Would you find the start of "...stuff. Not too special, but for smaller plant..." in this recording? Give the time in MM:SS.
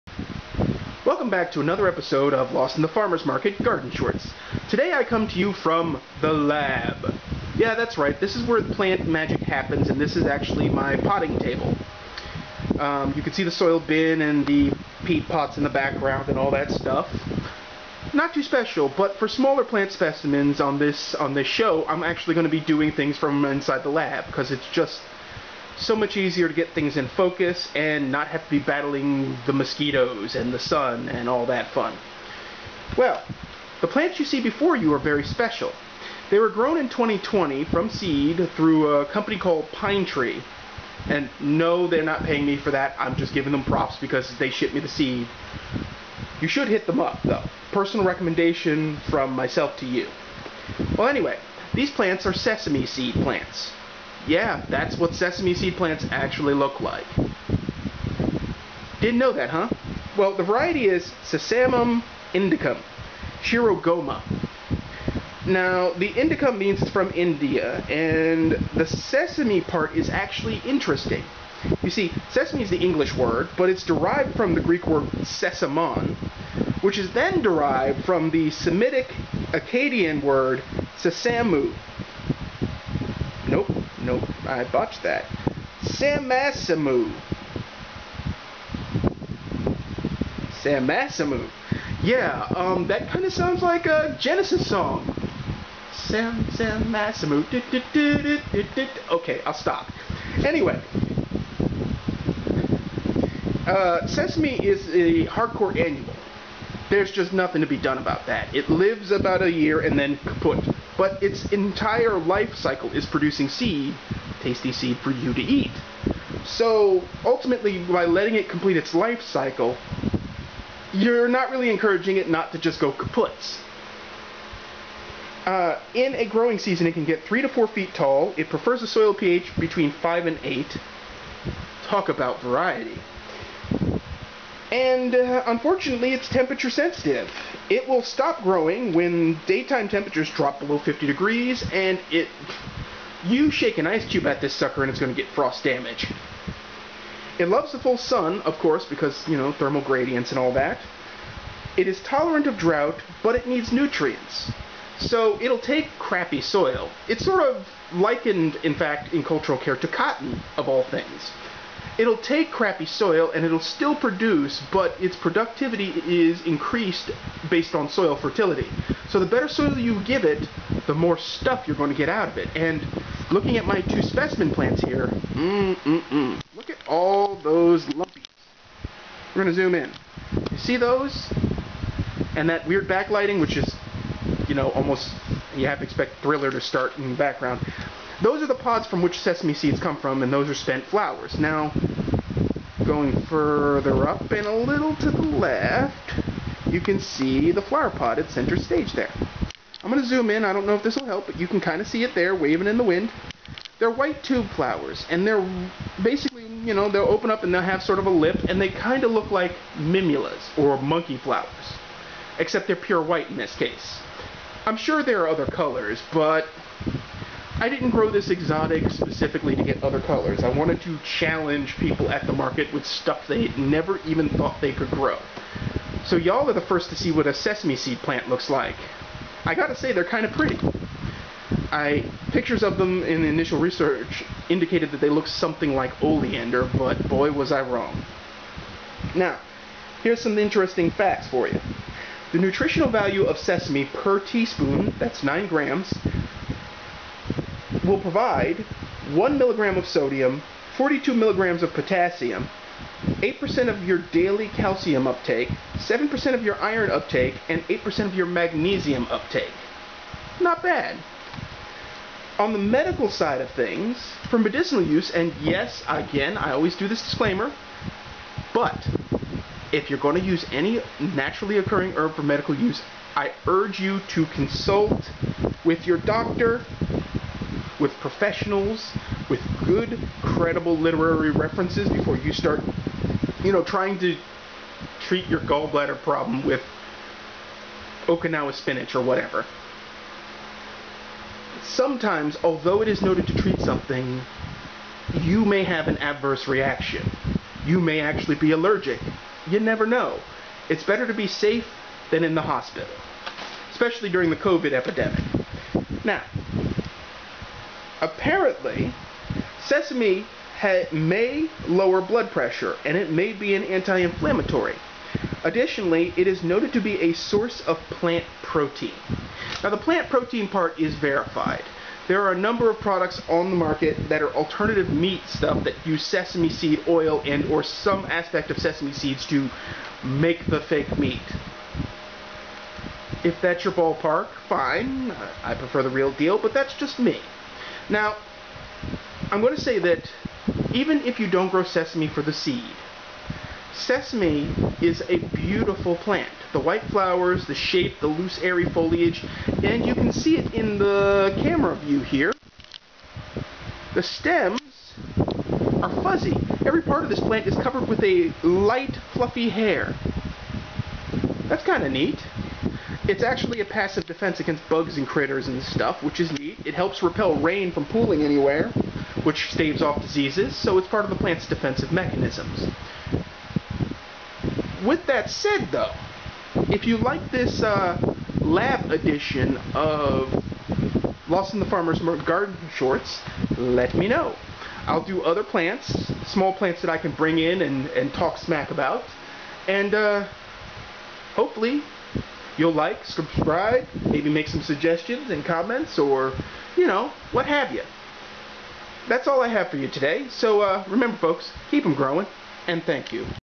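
00:16.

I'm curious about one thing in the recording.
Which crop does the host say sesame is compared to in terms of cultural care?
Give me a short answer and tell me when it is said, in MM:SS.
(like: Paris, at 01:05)
cotton, at 02:39.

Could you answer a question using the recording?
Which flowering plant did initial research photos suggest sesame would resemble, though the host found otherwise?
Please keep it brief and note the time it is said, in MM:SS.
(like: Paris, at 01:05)
oleander, at 03:56.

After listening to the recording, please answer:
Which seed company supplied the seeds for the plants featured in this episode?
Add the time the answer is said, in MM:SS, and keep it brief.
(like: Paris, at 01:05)
Pinetree, at 00:39.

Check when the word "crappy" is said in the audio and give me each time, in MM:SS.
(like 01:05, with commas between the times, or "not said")
02:35, 02:42.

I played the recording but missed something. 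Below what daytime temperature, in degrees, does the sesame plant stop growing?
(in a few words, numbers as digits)
50.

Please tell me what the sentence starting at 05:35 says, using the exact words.
I prefer the real deal, but that's just me.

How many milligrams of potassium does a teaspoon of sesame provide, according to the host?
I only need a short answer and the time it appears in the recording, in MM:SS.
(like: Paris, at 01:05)
42, at 04:10.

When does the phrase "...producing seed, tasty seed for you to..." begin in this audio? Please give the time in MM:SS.
01:53.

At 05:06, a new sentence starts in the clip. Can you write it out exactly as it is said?
Now, apparently, sesame may lower blood pressure and it may be an anti inflammatory.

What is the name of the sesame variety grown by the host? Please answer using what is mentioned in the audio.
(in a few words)
Shirogoma.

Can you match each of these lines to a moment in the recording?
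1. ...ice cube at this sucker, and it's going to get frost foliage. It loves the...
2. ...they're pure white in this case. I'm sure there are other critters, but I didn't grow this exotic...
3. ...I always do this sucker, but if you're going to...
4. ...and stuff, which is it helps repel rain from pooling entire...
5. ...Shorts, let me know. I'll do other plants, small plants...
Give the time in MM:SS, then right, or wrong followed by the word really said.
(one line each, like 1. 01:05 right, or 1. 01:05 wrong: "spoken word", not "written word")
1. 02:23 wrong: "damage", not "foliage"
2. 03:32 wrong: "colors", not "critters"
3. 04:26 wrong: "disclaimer", not "sucker"
4. 06:05 wrong: "anywhere", not "entire"
5. 06:22 right.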